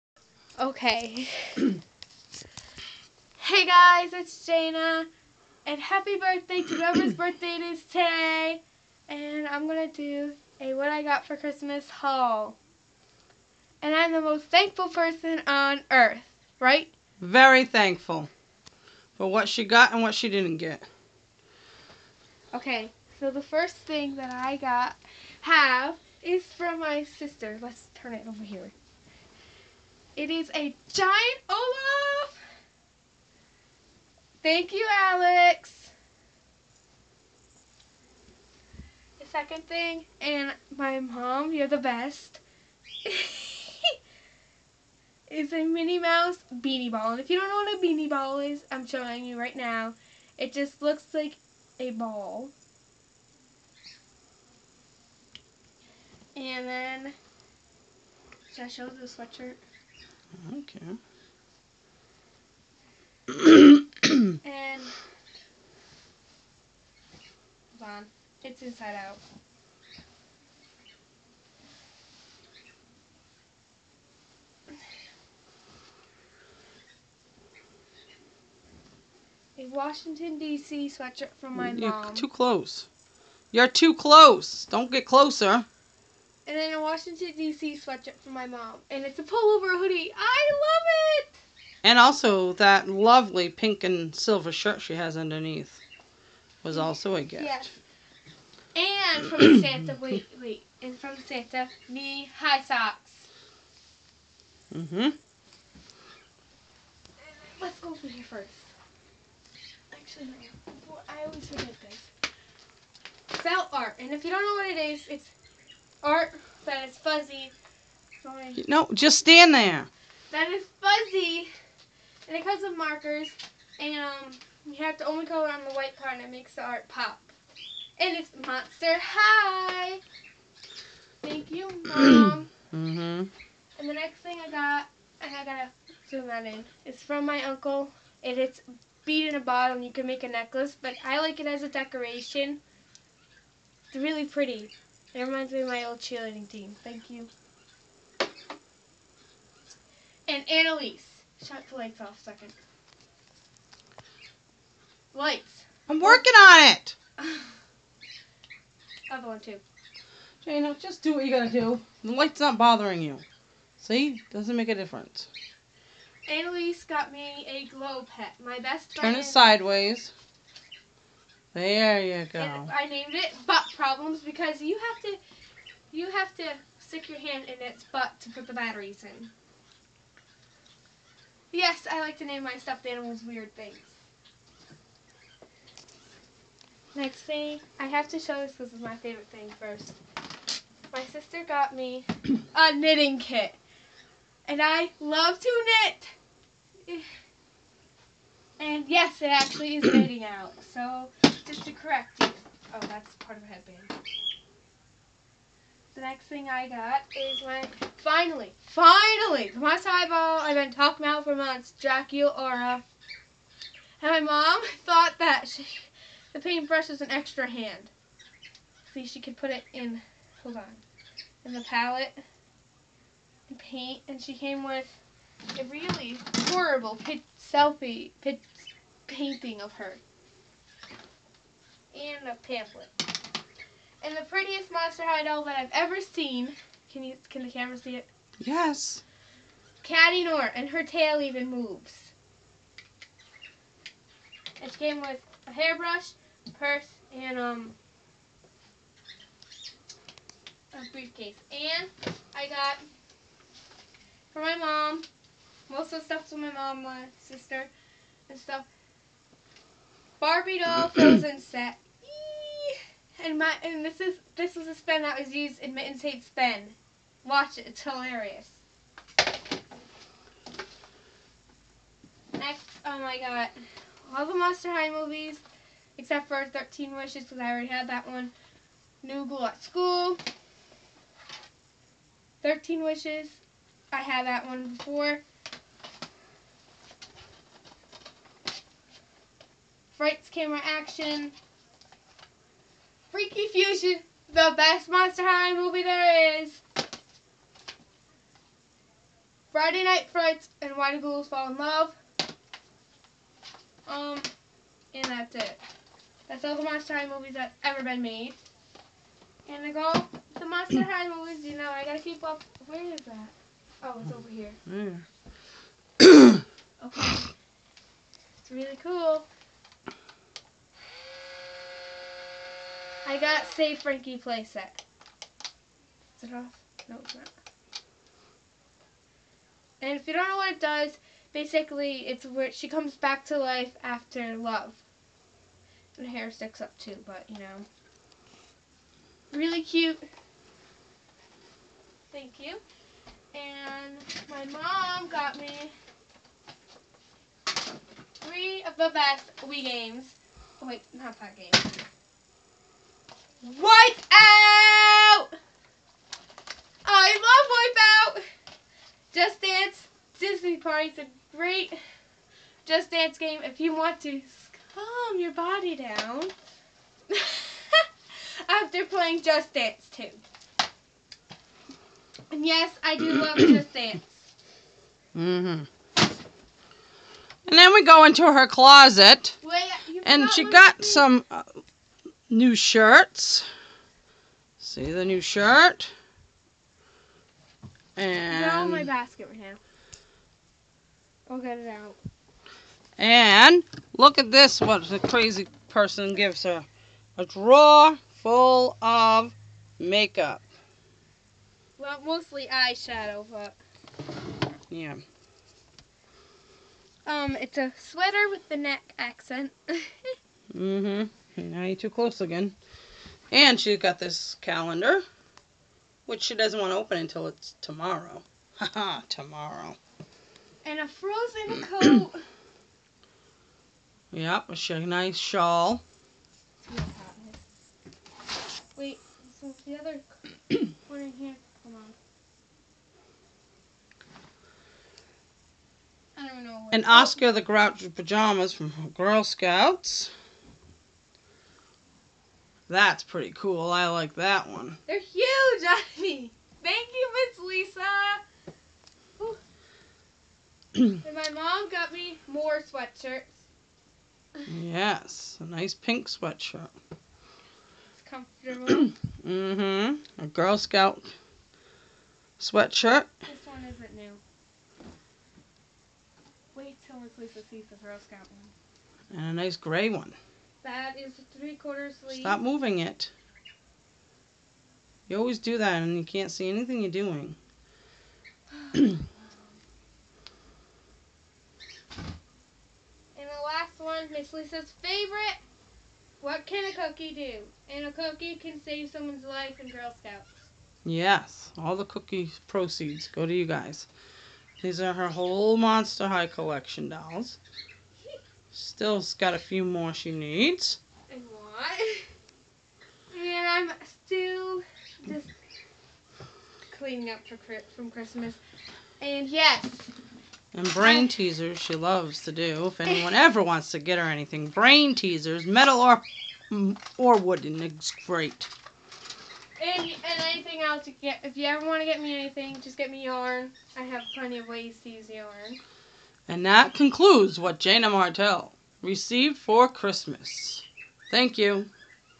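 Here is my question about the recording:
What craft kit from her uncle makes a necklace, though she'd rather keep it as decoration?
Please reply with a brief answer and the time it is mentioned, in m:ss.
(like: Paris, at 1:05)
Bead in a bottle, at 2:19.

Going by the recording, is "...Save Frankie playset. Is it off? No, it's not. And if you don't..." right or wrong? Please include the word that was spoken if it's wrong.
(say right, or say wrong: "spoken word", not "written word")
right.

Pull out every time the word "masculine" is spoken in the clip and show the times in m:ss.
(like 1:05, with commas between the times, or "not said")
not said.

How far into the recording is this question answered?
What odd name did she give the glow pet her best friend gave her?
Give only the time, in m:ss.
2:53.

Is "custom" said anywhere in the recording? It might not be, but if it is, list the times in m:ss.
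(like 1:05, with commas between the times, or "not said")
not said.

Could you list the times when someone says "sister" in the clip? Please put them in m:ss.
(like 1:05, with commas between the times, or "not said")
0:27, 3:11, 4:17.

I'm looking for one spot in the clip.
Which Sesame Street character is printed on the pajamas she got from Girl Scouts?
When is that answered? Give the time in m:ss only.
7:16.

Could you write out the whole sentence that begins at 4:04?
It came with a hairbrush, purse, and um a briefcase.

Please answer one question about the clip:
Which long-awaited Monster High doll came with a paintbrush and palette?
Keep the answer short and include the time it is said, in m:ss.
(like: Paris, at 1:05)
Draculaura, at 3:31.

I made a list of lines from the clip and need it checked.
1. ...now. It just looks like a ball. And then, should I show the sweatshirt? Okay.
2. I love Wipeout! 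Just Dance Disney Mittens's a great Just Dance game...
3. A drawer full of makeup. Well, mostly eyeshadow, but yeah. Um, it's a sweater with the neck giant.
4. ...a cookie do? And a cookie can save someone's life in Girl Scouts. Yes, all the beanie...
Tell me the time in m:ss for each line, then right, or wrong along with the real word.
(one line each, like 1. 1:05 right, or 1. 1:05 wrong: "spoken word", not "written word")
1. 0:49 right
2. 5:56 wrong: "Party", not "Mittens"
3. 6:37 wrong: "accent", not "giant"
4. 8:06 wrong: "cookie", not "beanie".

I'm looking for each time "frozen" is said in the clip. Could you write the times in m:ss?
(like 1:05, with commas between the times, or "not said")
4:20, 7:00.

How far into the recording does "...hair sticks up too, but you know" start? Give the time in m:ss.
5:36.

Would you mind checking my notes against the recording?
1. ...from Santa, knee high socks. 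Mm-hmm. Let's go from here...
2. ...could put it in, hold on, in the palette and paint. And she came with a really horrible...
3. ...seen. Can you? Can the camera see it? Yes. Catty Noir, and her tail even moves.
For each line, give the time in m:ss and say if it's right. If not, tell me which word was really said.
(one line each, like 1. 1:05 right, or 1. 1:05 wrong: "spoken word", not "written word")
1. 1:40 right
2. 3:39 right
3. 3:56 right.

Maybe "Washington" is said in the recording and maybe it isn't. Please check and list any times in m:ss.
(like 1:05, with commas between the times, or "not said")
1:19, 1:26.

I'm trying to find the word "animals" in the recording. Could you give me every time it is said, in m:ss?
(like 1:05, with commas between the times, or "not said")
3:02.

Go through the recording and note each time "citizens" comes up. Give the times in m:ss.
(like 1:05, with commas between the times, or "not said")
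not said.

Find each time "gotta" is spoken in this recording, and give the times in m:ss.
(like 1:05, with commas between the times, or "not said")
2:15, 2:41, 5:11.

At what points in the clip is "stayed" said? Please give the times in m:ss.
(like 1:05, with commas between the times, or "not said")
not said.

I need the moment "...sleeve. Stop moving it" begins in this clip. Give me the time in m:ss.
7:51.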